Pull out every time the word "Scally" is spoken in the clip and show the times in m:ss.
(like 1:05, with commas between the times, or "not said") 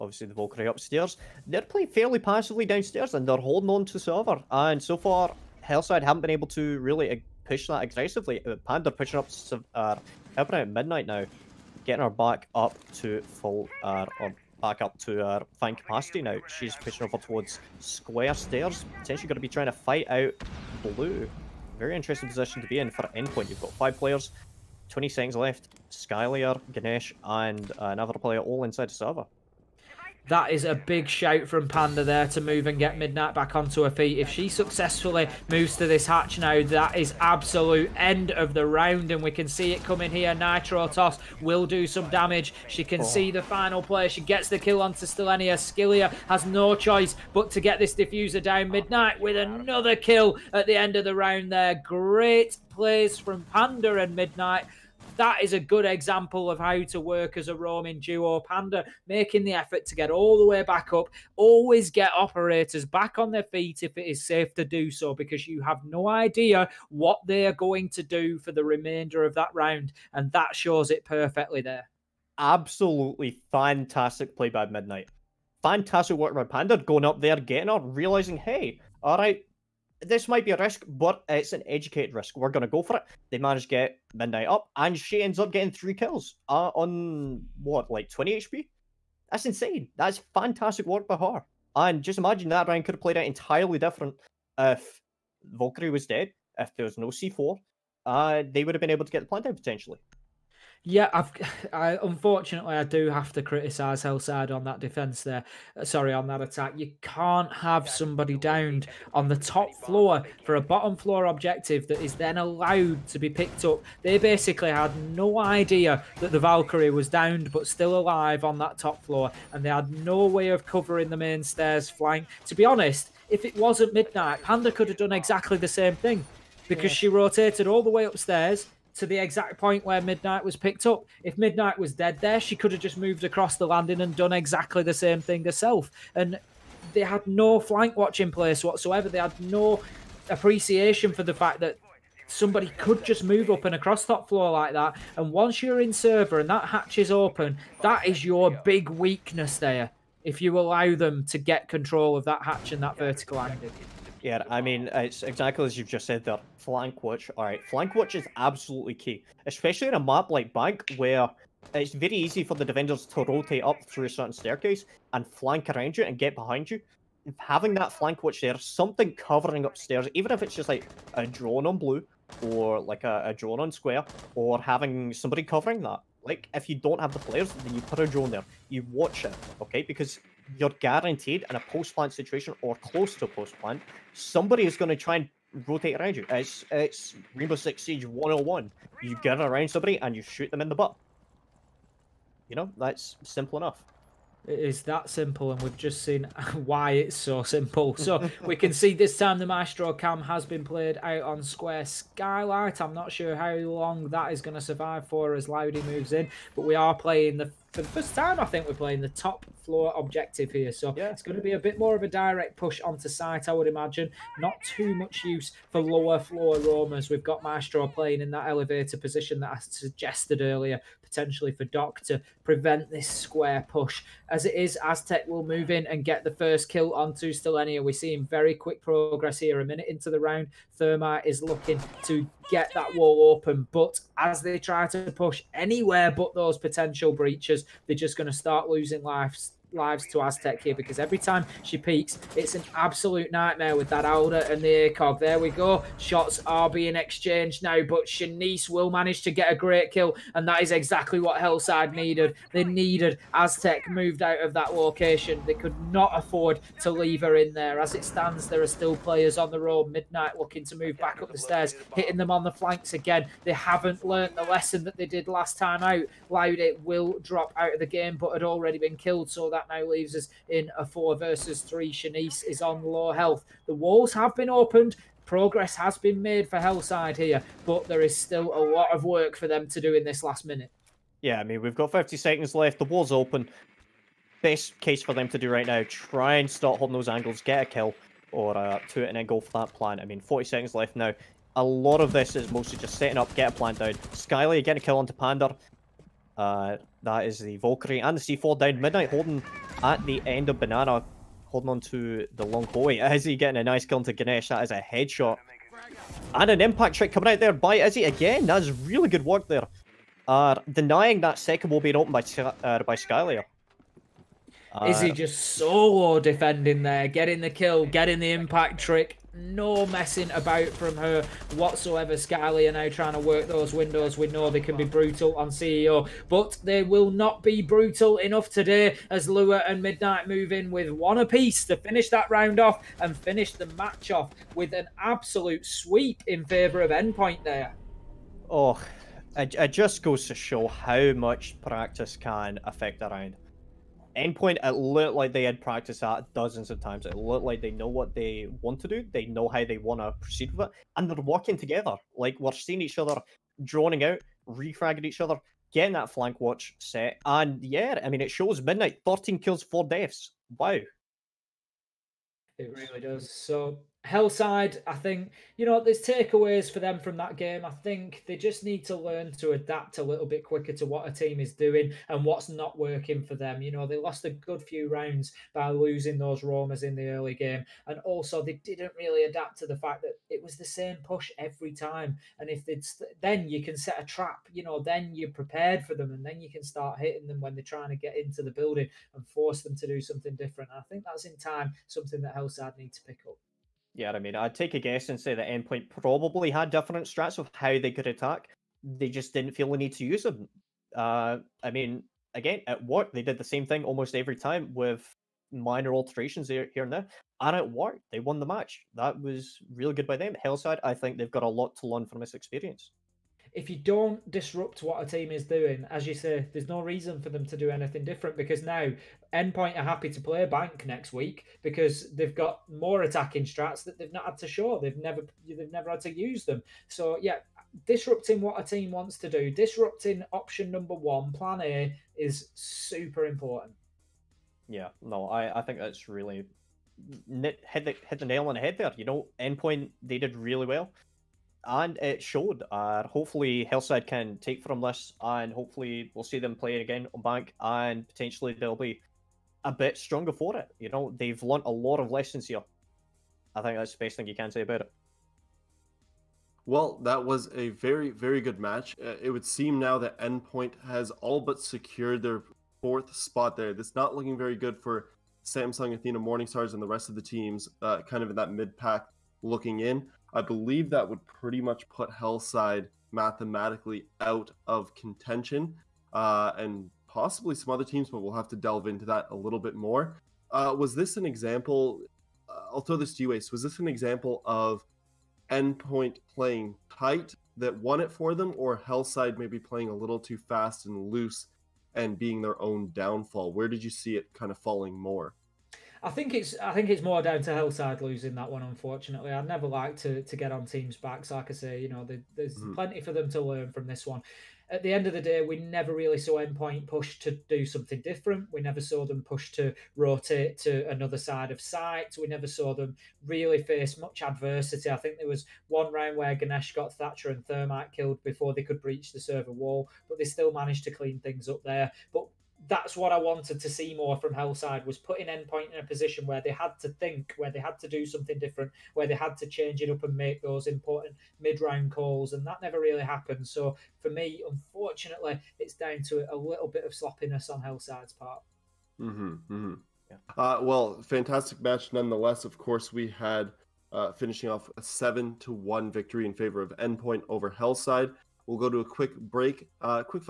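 5:22.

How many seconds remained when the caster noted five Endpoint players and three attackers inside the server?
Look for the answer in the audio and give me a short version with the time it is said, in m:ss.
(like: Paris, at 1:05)
20, at 0:24.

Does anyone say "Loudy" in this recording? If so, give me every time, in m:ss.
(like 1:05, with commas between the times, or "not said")
3:25, 4:26.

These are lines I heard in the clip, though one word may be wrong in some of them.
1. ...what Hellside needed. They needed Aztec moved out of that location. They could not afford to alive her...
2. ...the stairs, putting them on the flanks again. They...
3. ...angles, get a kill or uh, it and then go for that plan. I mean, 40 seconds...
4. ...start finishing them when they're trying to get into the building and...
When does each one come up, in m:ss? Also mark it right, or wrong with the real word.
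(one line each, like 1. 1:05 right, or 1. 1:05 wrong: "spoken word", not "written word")
1. 4:11 wrong: "leave", not "alive"
2. 4:21 wrong: "hitting", not "putting"
3. 4:47 right
4. 6:26 wrong: "hitting", not "finishing".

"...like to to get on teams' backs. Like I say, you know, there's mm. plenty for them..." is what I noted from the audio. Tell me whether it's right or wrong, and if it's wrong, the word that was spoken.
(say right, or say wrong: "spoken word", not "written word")
right.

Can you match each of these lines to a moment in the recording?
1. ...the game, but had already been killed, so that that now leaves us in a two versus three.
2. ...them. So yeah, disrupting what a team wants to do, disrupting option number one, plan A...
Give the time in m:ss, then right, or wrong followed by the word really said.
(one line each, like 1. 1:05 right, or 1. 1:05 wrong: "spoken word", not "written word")
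1. 4:27 wrong: "four", not "two"
2. 7:06 right.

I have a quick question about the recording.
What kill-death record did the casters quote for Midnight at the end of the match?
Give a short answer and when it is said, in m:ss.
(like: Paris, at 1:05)
13 kills, 4 deaths, at 5:59.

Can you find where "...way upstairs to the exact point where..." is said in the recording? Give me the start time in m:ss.
2:07.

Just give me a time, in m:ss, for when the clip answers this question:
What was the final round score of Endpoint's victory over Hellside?
9:04.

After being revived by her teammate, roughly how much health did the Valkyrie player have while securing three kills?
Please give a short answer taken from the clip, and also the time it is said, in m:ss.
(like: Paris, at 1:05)
20 HP, at 1:28.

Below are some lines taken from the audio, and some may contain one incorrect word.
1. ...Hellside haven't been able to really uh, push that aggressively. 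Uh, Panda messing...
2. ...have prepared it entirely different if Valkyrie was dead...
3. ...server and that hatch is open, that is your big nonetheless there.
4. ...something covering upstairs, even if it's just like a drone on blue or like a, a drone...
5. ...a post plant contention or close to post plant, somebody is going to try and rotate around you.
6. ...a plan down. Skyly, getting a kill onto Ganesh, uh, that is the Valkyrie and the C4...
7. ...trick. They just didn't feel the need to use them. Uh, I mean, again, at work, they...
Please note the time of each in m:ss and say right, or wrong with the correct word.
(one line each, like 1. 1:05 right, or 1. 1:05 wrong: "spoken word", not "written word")
1. 0:05 wrong: "pushing", not "messing"
2. 1:32 wrong: "played", not "prepared"
3. 2:25 wrong: "weakness", not "nonetheless"
4. 2:48 right
5. 3:01 wrong: "situation", not "contention"
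6. 4:53 wrong: "Panda", not "Ganesh"
7. 6:38 wrong: "attack", not "trick".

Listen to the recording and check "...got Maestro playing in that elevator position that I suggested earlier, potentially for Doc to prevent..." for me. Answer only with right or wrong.
right.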